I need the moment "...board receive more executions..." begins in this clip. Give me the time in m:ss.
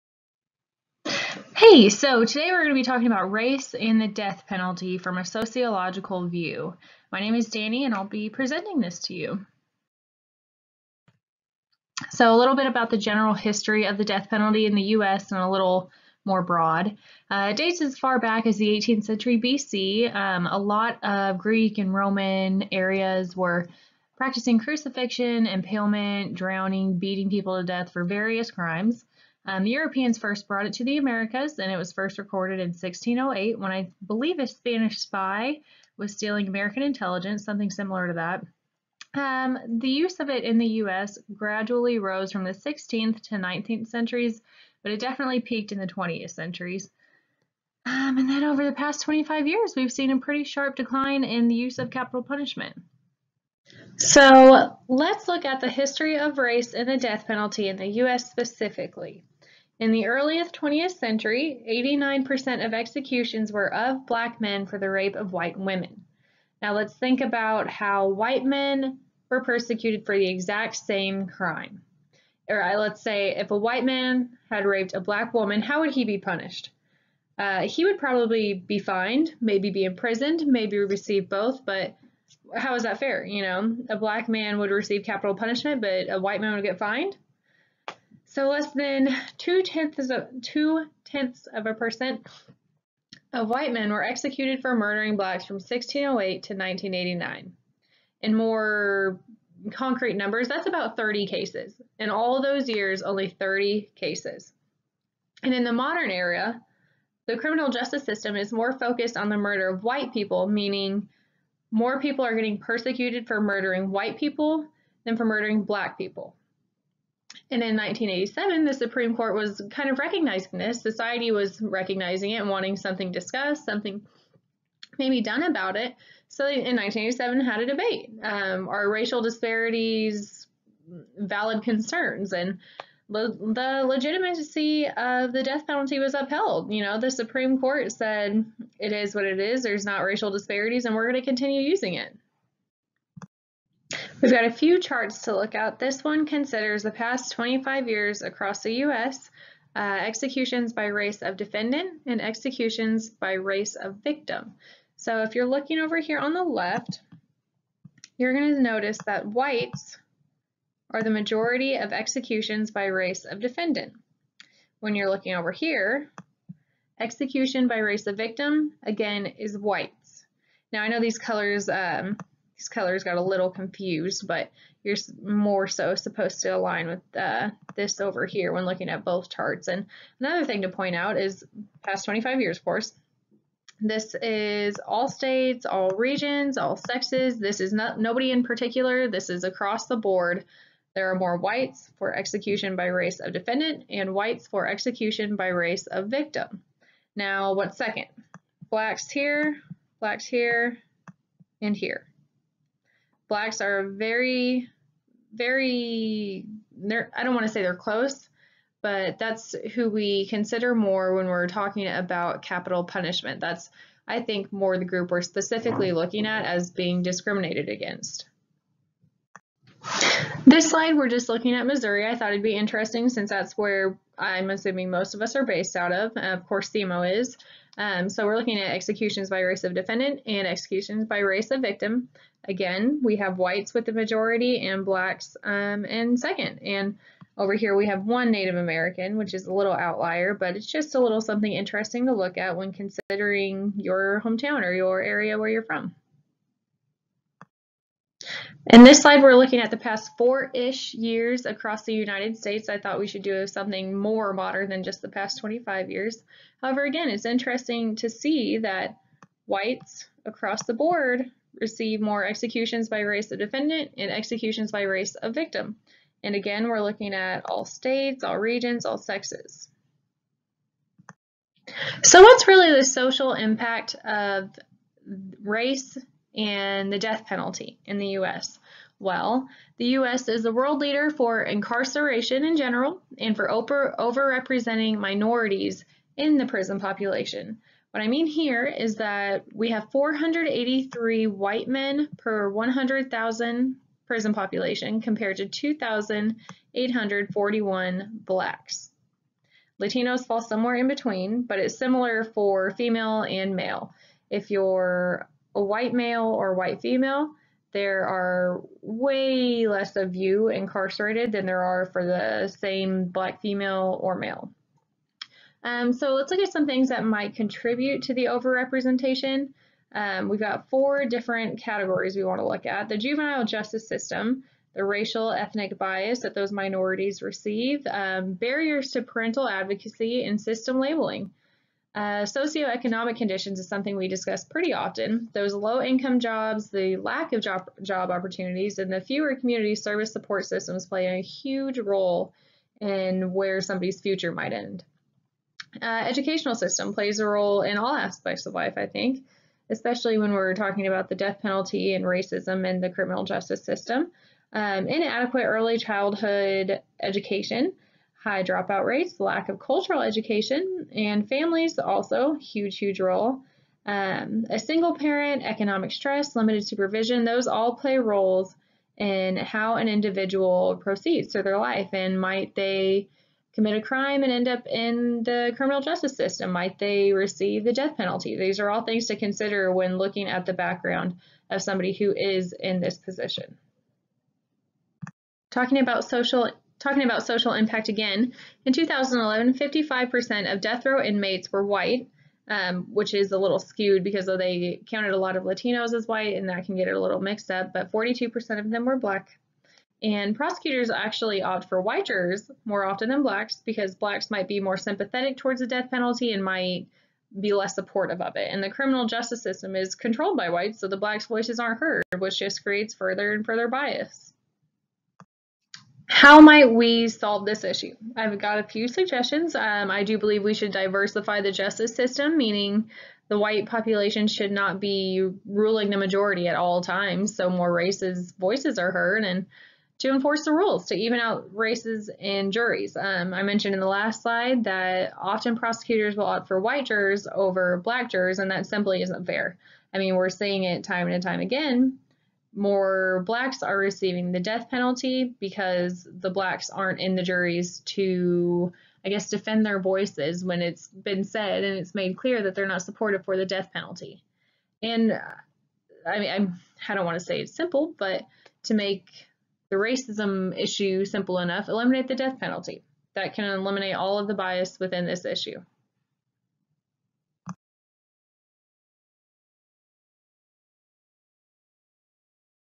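4:20.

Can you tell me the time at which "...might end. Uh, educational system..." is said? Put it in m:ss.
5:44.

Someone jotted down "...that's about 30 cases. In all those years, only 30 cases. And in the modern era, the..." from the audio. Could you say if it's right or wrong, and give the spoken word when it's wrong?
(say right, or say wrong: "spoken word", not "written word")
right.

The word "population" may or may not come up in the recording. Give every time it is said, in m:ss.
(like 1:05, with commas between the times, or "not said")
4:46, 4:54, 7:03.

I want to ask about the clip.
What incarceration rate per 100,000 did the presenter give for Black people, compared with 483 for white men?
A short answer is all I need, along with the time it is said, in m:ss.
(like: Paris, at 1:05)
2,841, at 4:55.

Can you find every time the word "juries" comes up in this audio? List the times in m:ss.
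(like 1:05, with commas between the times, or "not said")
7:12, 7:27.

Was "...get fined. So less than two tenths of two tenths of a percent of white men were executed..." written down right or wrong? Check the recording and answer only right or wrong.
right.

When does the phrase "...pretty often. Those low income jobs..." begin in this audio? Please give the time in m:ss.
5:34.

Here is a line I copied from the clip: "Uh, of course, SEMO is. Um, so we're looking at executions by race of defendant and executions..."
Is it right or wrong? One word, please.
right.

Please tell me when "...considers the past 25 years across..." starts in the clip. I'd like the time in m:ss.
2:26.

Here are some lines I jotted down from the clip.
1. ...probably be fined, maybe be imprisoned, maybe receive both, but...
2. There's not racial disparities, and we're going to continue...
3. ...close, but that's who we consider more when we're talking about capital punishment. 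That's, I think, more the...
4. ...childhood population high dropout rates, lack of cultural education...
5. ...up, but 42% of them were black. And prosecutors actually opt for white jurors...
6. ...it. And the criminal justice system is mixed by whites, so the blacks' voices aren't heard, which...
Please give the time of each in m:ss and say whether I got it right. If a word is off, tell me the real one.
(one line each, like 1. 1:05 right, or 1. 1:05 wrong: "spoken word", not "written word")
1. 1:17 right
2. 2:19 right
3. 3:27 right
4. 5:55 wrong: "education", not "population"
5. 6:37 right
6. 6:48 wrong: "controlled", not "mixed".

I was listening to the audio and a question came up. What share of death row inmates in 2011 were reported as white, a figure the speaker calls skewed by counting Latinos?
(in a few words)
55%.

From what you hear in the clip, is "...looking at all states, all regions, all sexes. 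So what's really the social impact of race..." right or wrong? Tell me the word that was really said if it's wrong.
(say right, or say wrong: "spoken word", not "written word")
right.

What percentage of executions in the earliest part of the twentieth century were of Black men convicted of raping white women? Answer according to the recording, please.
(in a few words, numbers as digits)
89%.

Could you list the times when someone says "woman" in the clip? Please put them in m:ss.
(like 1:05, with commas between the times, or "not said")
1:15.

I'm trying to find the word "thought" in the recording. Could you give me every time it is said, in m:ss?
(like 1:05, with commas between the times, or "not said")
3:42, 4:12.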